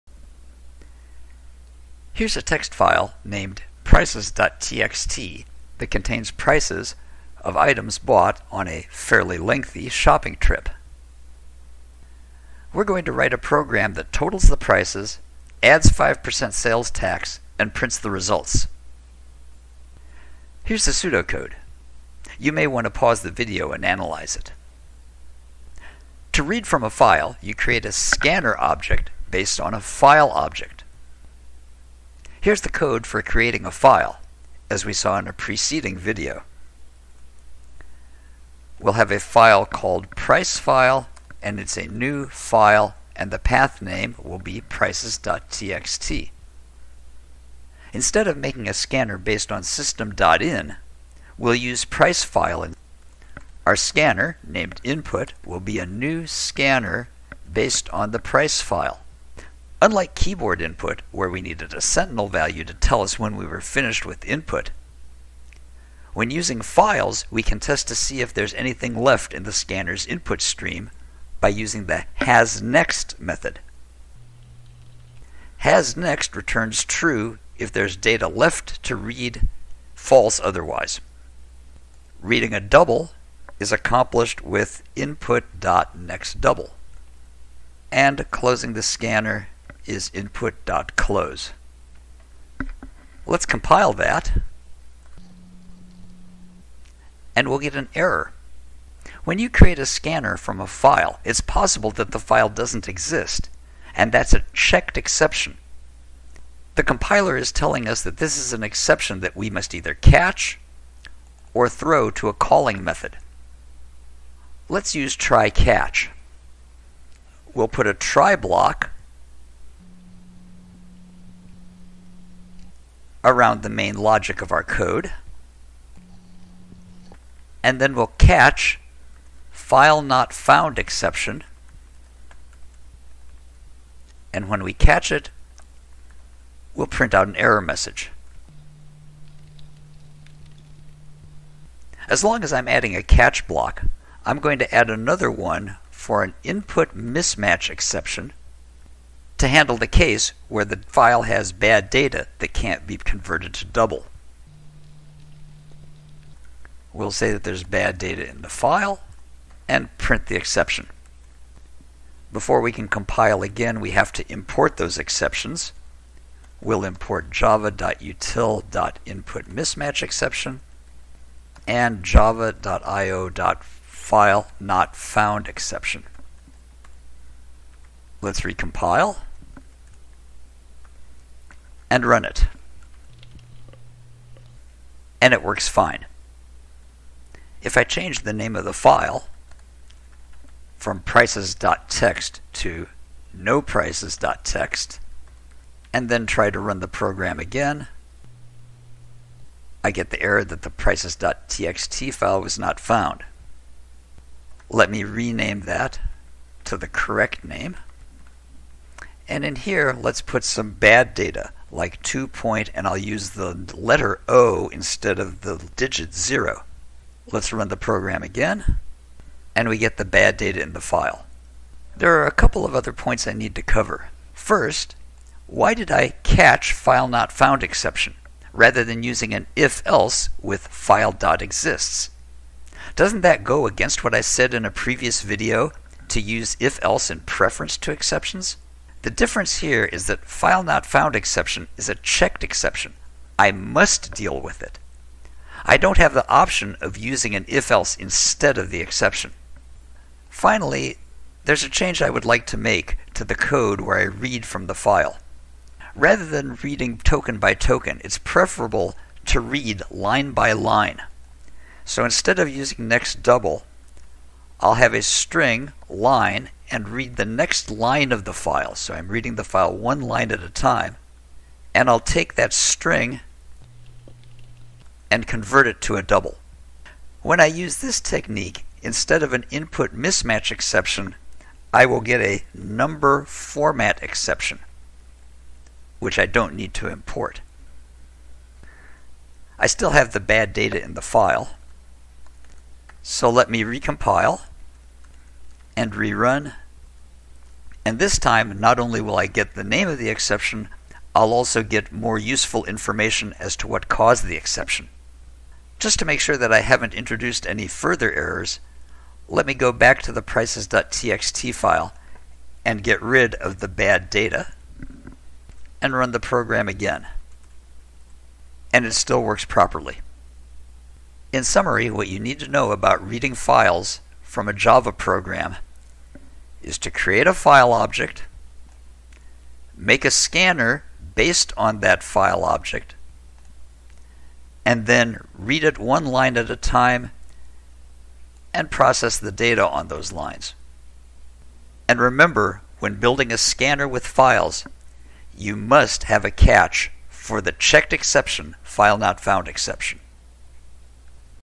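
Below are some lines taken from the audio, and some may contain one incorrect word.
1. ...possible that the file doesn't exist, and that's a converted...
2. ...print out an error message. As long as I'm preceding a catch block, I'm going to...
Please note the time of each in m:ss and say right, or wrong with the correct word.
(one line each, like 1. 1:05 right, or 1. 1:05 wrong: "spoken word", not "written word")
1. 1:41 wrong: "checked", not "converted"
2. 2:16 wrong: "adding", not "preceding".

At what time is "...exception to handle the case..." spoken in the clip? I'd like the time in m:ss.
2:27.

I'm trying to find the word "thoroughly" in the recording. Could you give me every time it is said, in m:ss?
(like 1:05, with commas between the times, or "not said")
not said.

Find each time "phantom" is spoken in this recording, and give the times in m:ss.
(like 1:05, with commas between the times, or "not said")
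not said.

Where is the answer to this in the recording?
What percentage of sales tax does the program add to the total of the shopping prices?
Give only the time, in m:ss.
0:15.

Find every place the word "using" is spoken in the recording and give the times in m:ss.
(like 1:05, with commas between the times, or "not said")
1:06, 1:11, 3:49, 4:06, 4:22.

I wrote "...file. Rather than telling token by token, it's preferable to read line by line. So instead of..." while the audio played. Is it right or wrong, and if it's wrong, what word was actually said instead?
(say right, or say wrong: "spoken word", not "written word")
wrong: "reading", not "telling".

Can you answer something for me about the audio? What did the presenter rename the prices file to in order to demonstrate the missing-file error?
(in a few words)
noprices.txt.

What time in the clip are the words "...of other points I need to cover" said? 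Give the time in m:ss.
3:42.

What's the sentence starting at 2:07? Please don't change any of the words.
And then we'll catch file not found exception.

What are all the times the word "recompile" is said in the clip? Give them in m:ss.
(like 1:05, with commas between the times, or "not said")
2:58, 4:53.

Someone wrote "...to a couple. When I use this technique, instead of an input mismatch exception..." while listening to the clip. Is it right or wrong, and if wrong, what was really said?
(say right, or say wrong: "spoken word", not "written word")
wrong: "double", not "couple".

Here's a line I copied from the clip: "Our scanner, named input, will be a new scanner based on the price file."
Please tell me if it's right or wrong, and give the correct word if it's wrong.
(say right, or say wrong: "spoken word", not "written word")
right.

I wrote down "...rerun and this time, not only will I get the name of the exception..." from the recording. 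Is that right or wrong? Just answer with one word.
right.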